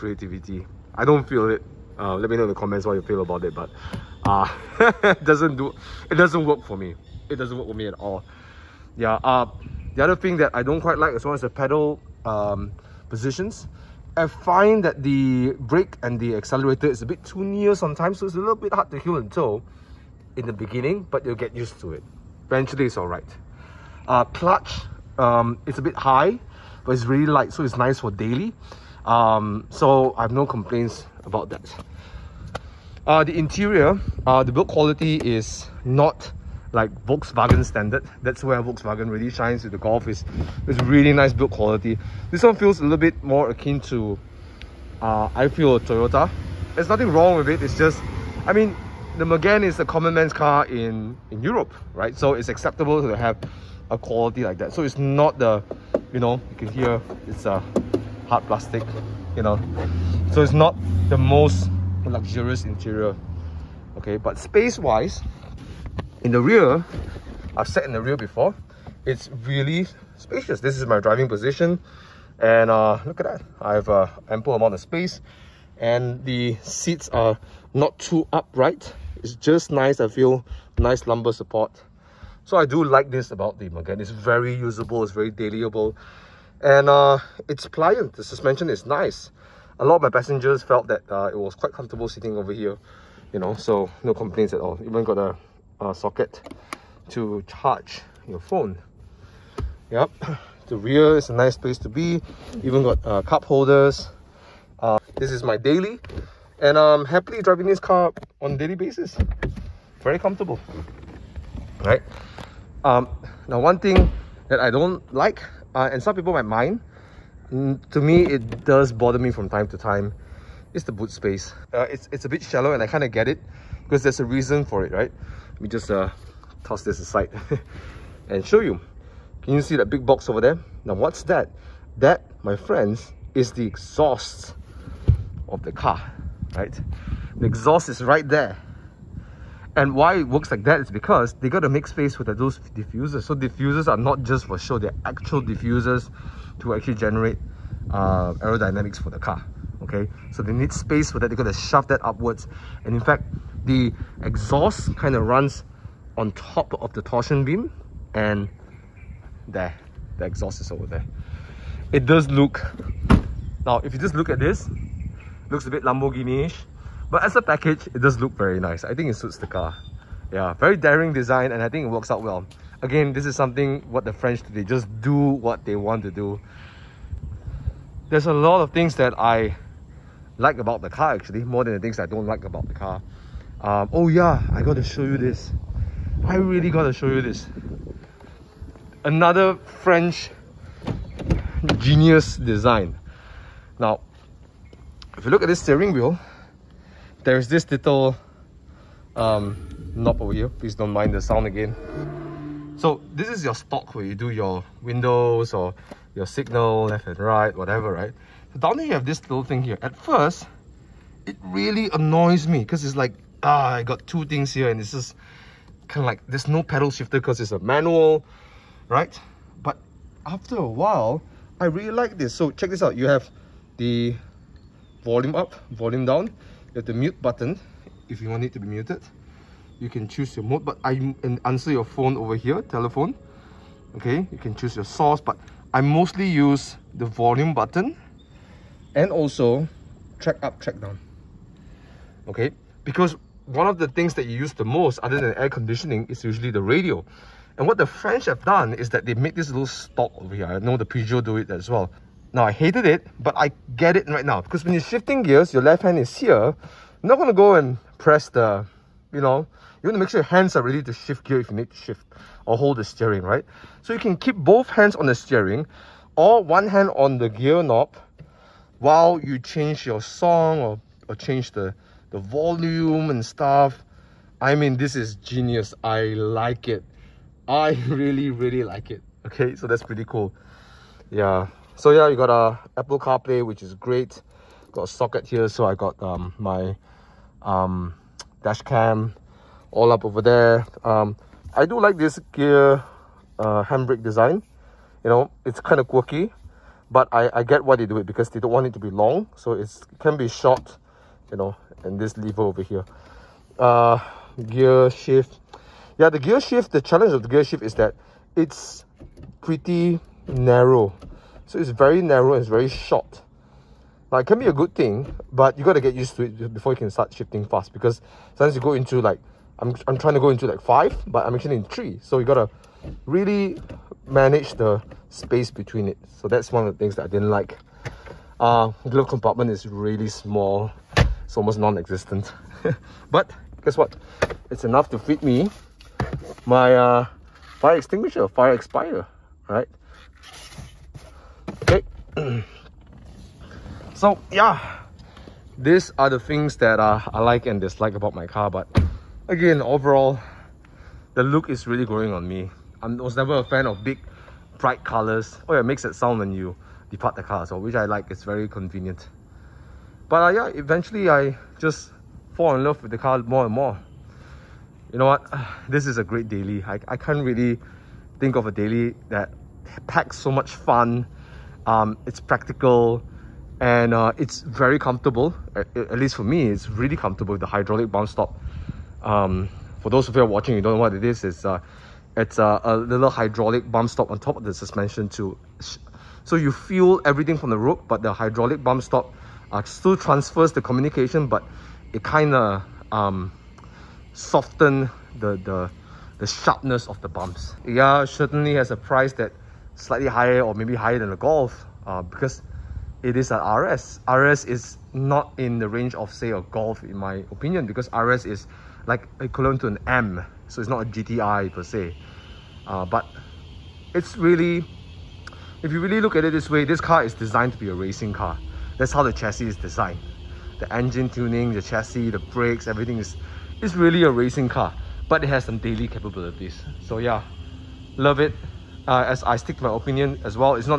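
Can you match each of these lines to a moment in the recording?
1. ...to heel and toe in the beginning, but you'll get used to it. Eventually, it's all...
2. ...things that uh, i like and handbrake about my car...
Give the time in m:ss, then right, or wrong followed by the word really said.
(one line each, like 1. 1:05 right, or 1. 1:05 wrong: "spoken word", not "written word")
1. 0:18 right
2. 5:46 wrong: "dislike", not "handbrake".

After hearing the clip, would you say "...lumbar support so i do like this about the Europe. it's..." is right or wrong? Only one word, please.
wrong.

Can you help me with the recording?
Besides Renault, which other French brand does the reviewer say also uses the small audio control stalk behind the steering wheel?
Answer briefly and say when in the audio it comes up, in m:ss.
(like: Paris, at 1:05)
Peugeot, at 4:10.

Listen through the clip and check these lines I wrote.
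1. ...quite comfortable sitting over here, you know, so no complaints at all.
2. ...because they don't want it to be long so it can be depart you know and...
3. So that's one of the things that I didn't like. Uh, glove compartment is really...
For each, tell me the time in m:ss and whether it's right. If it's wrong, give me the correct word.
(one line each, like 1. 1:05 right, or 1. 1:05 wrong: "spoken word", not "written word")
1. 1:31 right
2. 4:58 wrong: "short", not "depart"
3. 5:26 right.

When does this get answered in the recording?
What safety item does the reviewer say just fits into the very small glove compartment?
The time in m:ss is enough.
5:37.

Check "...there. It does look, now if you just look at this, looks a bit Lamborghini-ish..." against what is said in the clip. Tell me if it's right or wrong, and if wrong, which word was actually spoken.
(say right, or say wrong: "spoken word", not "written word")
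right.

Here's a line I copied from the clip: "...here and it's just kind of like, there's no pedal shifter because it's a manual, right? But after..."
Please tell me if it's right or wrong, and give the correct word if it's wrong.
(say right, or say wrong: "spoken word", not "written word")
right.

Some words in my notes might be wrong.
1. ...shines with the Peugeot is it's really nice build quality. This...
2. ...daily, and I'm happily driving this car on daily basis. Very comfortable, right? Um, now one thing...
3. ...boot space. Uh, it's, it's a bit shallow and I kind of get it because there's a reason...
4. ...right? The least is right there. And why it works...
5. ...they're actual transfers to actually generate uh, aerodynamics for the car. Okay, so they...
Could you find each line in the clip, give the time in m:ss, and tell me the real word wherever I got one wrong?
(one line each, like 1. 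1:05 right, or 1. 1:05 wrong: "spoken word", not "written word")
1. 0:39 wrong: "Golf", not "Peugeot"
2. 1:45 right
3. 2:00 right
4. 2:16 wrong: "exhaust", not "least"
5. 2:24 wrong: "diffusers", not "transfers".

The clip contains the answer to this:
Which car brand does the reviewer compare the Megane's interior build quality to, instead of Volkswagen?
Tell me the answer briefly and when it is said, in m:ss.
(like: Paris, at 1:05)
Toyota, at 0:45.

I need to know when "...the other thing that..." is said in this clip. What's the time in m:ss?
0:09.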